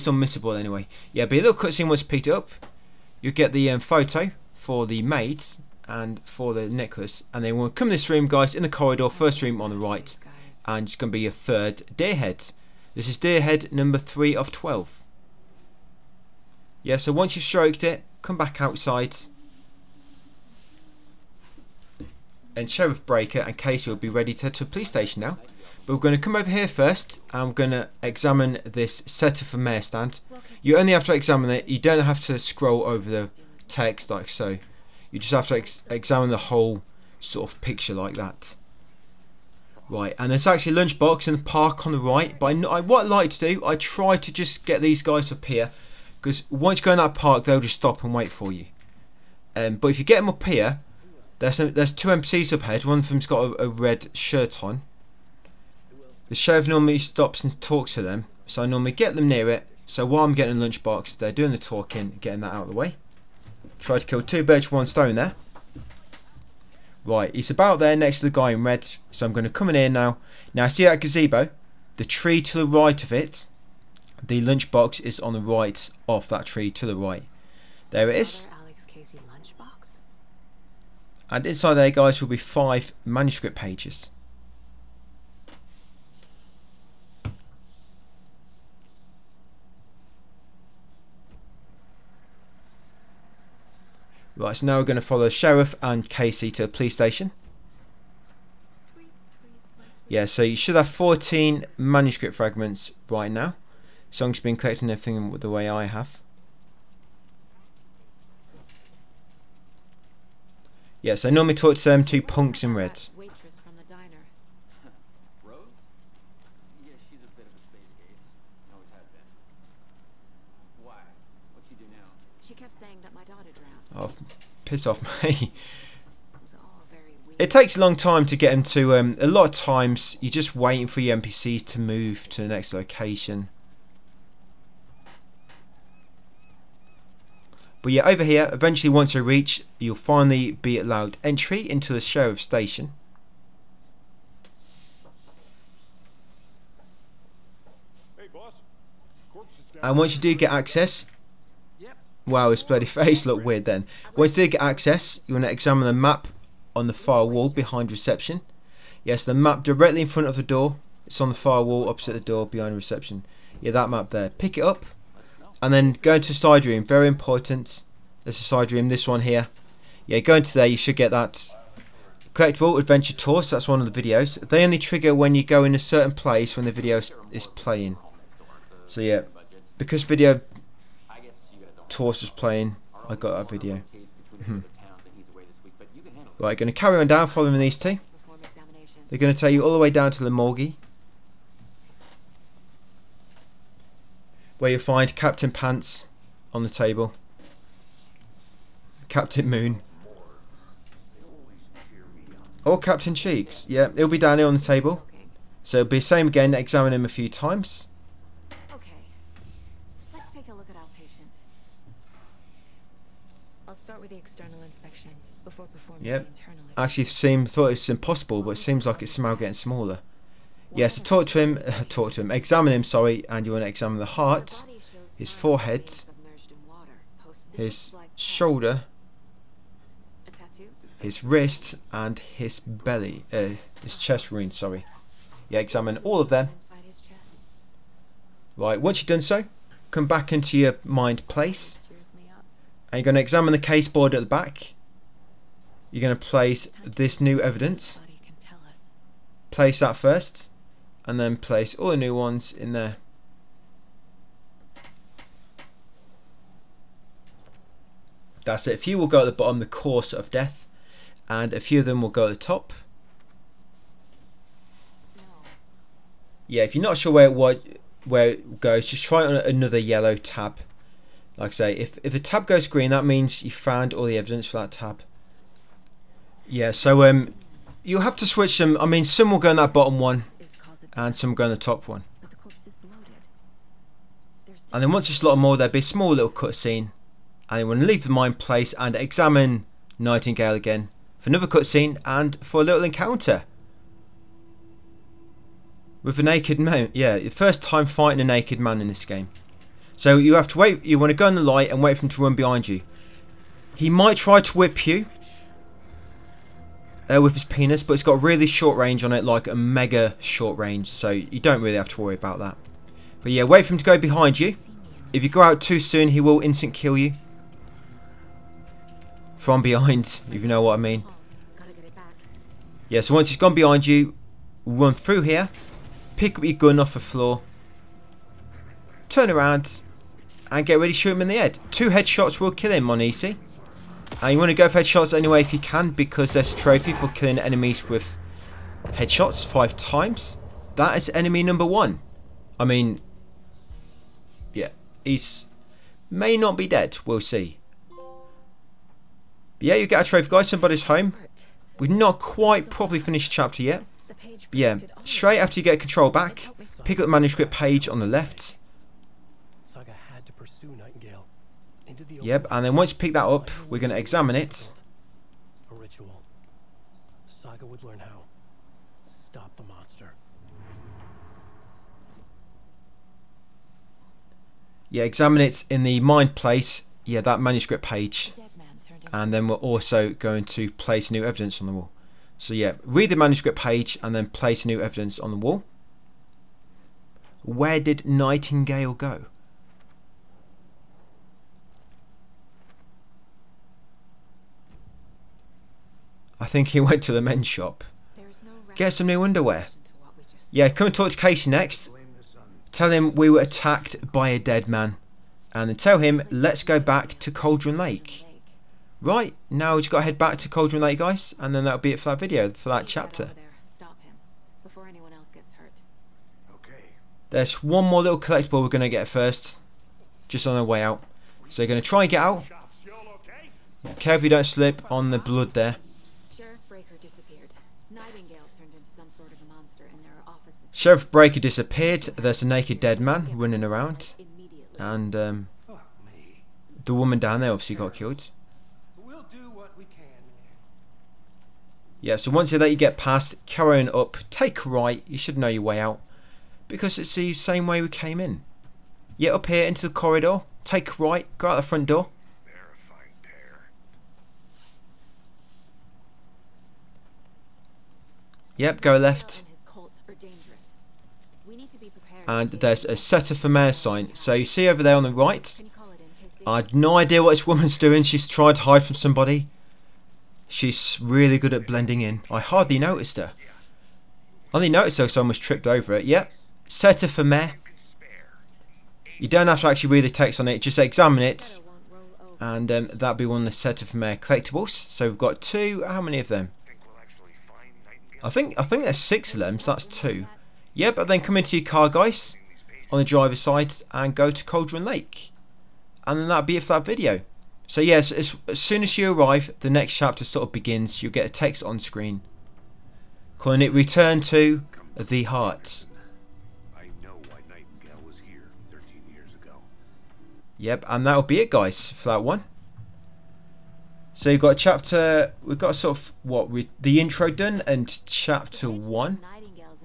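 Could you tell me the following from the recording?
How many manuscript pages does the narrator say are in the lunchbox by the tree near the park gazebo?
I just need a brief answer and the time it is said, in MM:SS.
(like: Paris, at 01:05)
5, at 01:22.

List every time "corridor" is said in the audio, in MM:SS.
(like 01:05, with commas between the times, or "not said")
00:08, 07:29.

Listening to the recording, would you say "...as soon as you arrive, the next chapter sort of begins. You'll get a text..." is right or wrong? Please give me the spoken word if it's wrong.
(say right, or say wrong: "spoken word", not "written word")
right.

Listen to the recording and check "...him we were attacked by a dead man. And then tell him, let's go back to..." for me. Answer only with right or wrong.
right.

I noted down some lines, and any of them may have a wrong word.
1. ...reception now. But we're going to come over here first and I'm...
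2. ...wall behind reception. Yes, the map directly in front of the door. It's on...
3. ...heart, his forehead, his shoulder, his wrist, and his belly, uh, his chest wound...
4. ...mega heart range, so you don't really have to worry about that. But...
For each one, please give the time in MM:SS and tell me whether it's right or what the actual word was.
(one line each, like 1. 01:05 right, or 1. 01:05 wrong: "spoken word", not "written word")
1. 00:24 wrong: "station", not "reception"
2. 02:37 right
3. 03:44 right
4. 05:09 wrong: "short", not "heart".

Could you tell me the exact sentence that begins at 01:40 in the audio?
Yeah, so you should have 14 manuscript fragments right now.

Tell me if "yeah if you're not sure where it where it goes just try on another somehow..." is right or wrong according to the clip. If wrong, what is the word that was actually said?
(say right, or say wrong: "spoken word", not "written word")
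wrong: "yellow", not "somehow".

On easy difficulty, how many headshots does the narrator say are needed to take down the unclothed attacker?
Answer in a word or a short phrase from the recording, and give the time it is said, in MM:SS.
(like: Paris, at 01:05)
2, at 05:31.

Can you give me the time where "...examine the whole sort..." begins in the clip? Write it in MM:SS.
00:35.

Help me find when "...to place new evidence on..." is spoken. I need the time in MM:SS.
06:20.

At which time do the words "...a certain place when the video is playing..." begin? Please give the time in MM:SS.
02:55.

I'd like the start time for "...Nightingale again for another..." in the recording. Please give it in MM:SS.
04:49.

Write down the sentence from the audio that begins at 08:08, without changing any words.
I think I think there's six of them, so that's two.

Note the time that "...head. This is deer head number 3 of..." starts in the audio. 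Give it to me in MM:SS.
00:12.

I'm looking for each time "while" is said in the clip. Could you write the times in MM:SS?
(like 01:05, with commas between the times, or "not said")
01:00.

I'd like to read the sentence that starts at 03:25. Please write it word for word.
So it'll be the same again, examine him a few times.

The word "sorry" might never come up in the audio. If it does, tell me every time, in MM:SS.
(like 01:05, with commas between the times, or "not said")
03:42, 03:54.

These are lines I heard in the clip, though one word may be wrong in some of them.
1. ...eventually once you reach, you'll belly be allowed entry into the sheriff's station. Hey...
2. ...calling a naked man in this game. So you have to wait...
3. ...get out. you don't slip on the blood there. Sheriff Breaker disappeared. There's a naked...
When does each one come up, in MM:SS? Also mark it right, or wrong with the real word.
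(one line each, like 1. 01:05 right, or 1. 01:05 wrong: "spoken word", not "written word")
1. 02:18 wrong: "finally", not "belly"
2. 04:57 wrong: "fighting", not "calling"
3. 07:02 right.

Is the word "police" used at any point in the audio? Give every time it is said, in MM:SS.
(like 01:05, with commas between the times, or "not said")
00:24, 01:36.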